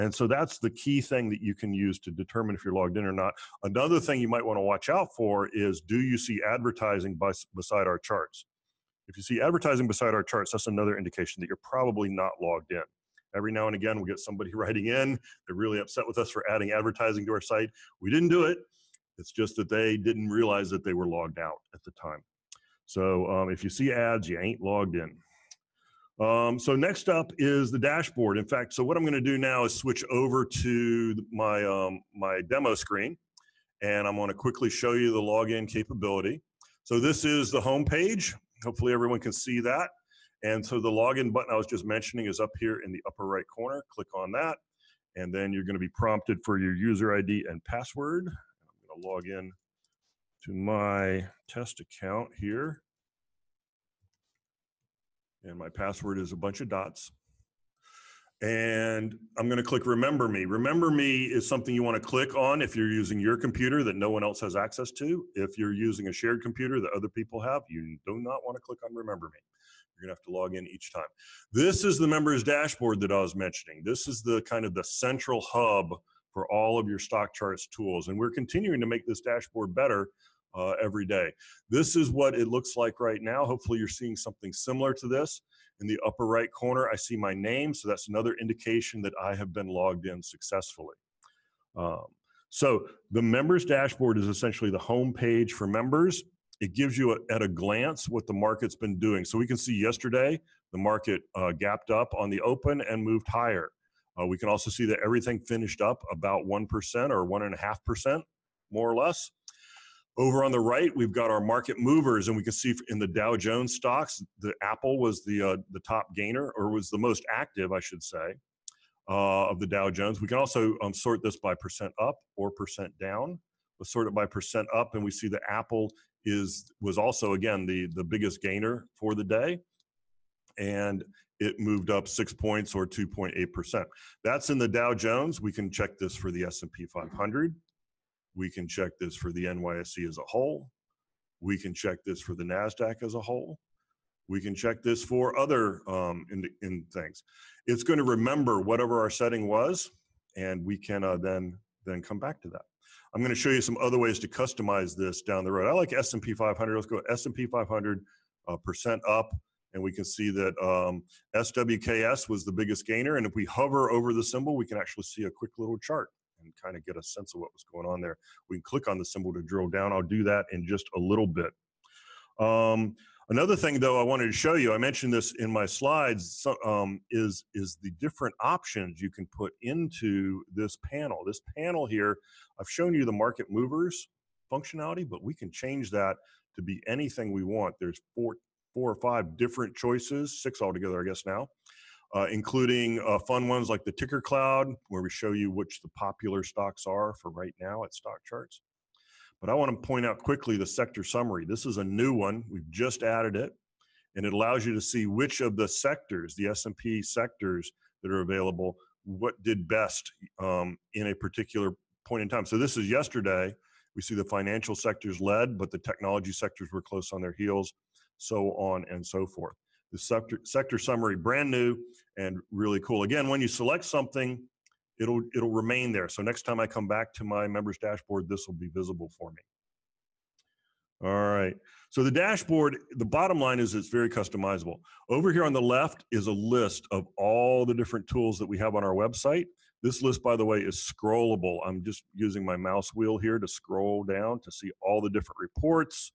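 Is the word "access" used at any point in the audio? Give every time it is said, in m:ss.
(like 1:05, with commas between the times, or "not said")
1:04.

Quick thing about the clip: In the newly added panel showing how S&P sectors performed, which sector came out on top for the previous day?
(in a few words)
Financial.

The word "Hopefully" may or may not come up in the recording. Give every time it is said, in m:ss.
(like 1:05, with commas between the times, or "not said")
0:38, 1:23.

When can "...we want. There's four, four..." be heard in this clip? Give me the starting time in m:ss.
3:07.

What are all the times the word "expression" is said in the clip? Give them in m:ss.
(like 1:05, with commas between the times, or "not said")
not said.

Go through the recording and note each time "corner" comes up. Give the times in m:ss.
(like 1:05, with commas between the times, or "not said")
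0:43, 1:26.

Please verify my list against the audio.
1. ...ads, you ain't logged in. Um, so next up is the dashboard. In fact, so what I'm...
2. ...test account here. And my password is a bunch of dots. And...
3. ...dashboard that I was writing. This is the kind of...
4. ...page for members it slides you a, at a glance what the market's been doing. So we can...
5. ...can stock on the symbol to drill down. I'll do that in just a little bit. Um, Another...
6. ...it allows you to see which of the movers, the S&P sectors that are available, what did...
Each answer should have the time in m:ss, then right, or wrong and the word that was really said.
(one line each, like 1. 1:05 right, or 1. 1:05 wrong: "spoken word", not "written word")
1. 0:23 right
2. 0:51 right
3. 1:12 wrong: "mentioning", not "writing"
4. 1:35 wrong: "gives", not "slides"
5. 2:48 wrong: "click", not "stock"
6. 3:24 wrong: "sectors", not "movers".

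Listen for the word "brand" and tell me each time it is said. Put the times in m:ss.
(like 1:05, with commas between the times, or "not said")
3:41.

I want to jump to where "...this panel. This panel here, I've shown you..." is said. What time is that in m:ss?
3:00.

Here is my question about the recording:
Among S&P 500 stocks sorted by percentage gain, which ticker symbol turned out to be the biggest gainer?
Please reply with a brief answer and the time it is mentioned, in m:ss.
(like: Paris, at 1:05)
SWKS, at 2:41.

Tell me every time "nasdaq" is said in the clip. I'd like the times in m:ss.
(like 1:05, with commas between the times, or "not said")
2:22.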